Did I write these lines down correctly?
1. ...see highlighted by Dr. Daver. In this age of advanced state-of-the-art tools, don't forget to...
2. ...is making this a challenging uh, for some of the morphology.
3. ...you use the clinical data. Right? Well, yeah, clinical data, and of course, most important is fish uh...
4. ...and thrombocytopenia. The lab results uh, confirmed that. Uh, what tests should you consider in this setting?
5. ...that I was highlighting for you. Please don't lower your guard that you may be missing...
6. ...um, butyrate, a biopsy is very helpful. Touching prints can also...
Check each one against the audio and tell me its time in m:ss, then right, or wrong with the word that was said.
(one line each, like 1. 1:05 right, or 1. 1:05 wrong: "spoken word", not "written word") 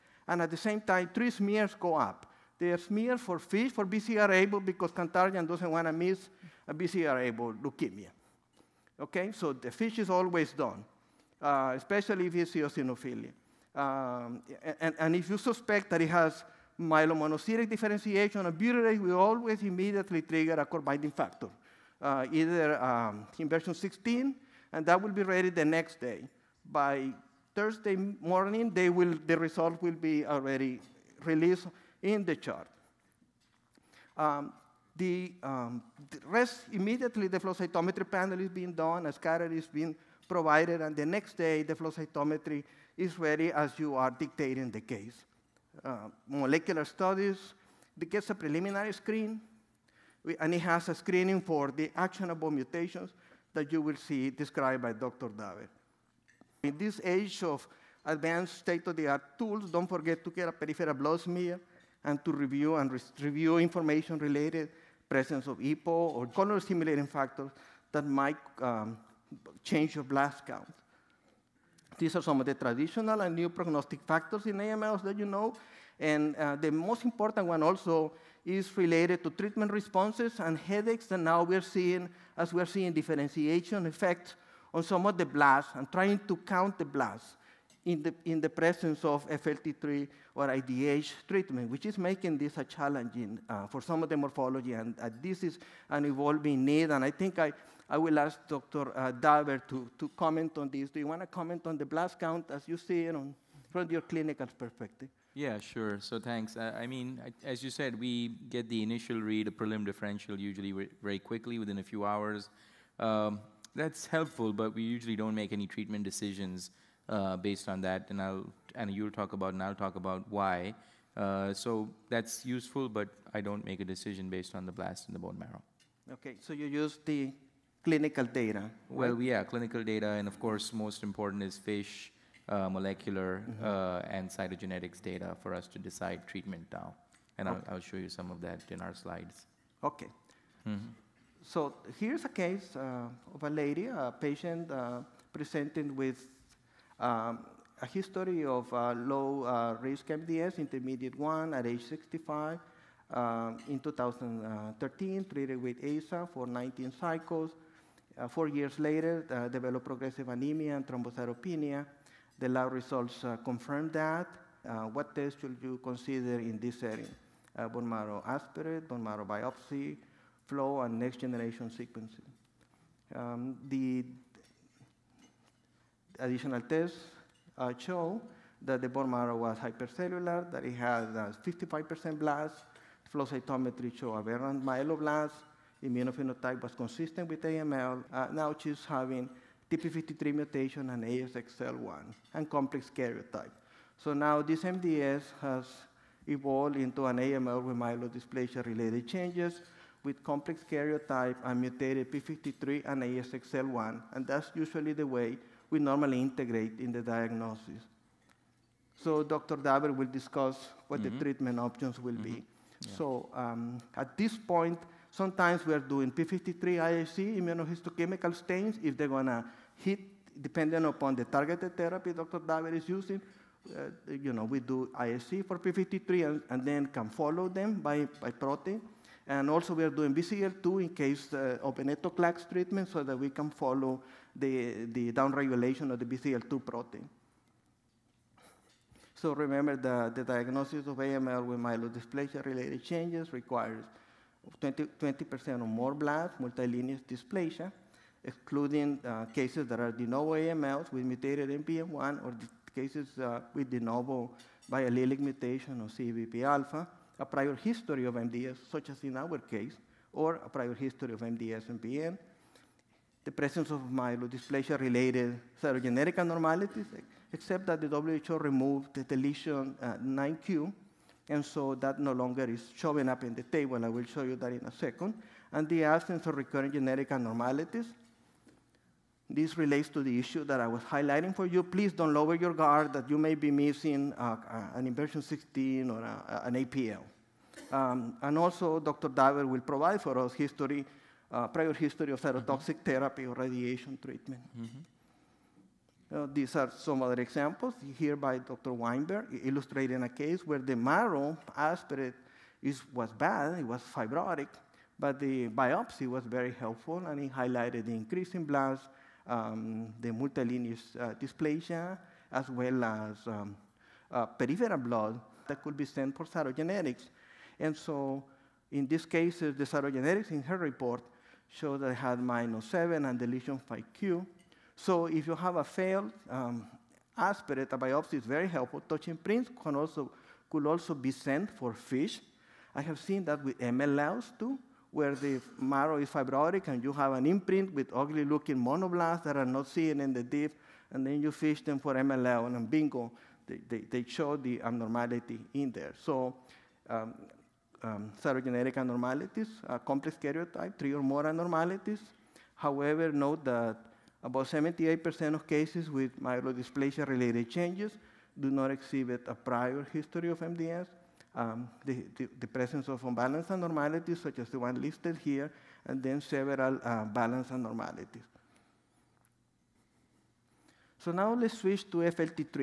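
1. 0:53 wrong: "described", not "highlighted"
2. 1:31 right
3. 2:06 right
4. 2:40 right
5. 4:40 right
6. 5:26 wrong: "aspirate", not "butyrate".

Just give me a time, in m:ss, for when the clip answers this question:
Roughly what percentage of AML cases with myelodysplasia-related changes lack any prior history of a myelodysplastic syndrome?
5:54.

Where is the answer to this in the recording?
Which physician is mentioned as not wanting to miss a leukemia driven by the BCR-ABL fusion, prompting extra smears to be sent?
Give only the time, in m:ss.
0:04.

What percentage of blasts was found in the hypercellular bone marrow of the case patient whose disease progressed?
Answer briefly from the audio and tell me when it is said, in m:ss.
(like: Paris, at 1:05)
55%, at 3:01.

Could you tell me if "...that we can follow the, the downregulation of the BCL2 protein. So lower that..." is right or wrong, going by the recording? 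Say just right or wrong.
wrong.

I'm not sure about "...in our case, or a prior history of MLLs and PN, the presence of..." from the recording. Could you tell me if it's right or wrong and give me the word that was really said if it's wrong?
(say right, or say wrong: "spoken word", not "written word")
wrong: "MDS", not "MLLs".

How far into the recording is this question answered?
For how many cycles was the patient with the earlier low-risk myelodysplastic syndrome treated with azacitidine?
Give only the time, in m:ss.
2:36.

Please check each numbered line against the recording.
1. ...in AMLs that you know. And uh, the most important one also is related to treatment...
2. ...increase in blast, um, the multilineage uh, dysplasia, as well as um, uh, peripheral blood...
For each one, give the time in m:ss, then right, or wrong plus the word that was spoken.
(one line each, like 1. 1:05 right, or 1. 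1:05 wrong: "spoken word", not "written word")
1. 1:14 right
2. 5:07 right.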